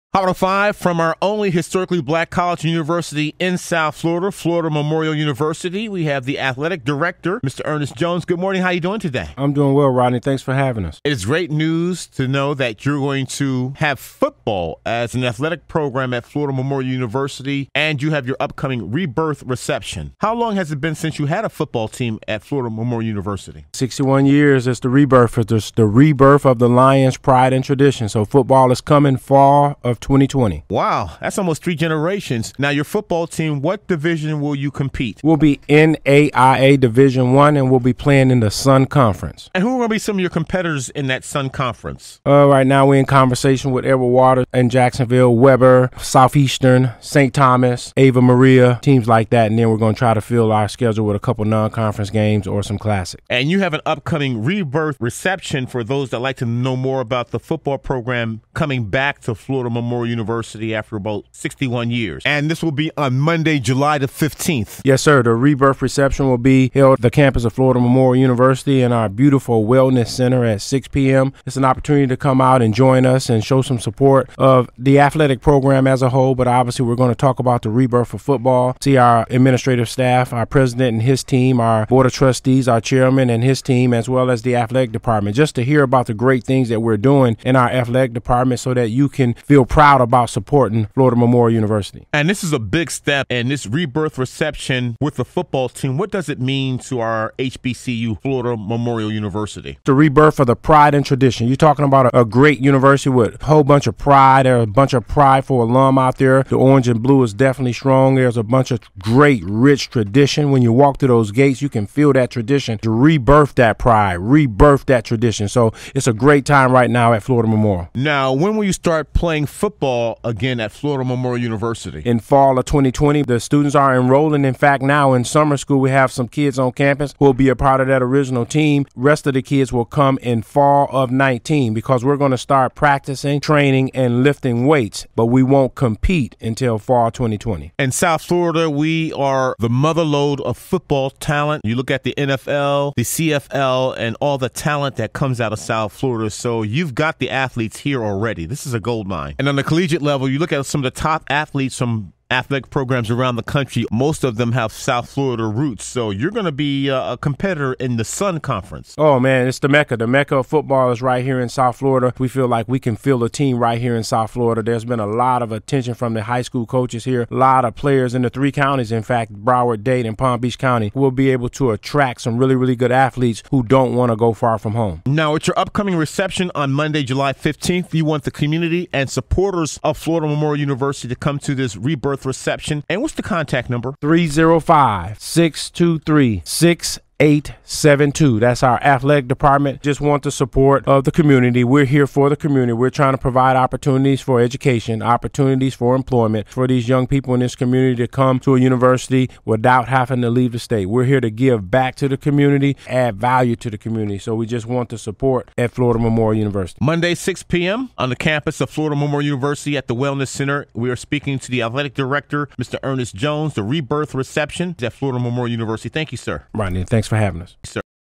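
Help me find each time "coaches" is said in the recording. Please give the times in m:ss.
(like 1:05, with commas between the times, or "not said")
2:46.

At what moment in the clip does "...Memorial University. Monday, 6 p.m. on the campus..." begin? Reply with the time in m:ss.
3:25.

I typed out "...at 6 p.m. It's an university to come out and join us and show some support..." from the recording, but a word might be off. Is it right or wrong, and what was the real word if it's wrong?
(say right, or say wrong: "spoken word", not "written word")
wrong: "opportunity", not "university".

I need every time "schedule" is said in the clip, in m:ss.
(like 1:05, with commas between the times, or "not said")
0:50.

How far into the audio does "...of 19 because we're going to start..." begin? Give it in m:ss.
2:10.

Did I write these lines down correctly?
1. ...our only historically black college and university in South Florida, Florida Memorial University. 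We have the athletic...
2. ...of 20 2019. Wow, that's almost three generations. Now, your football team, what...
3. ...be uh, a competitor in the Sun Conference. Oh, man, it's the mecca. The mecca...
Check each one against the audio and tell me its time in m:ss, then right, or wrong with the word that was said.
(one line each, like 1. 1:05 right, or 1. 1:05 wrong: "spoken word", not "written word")
1. 0:00 right
2. 0:29 wrong: "2020", not "2019"
3. 2:36 right.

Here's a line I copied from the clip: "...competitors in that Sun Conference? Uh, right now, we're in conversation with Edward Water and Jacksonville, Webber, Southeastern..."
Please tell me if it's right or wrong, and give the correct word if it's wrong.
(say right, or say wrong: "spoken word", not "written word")
right.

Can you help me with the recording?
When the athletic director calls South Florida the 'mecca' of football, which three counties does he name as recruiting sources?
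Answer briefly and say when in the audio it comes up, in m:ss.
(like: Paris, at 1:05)
Broward, Dade, and Palm Beach, at 2:49.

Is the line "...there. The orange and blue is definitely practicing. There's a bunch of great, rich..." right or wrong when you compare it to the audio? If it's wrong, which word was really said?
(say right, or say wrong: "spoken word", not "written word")
wrong: "strong", not "practicing".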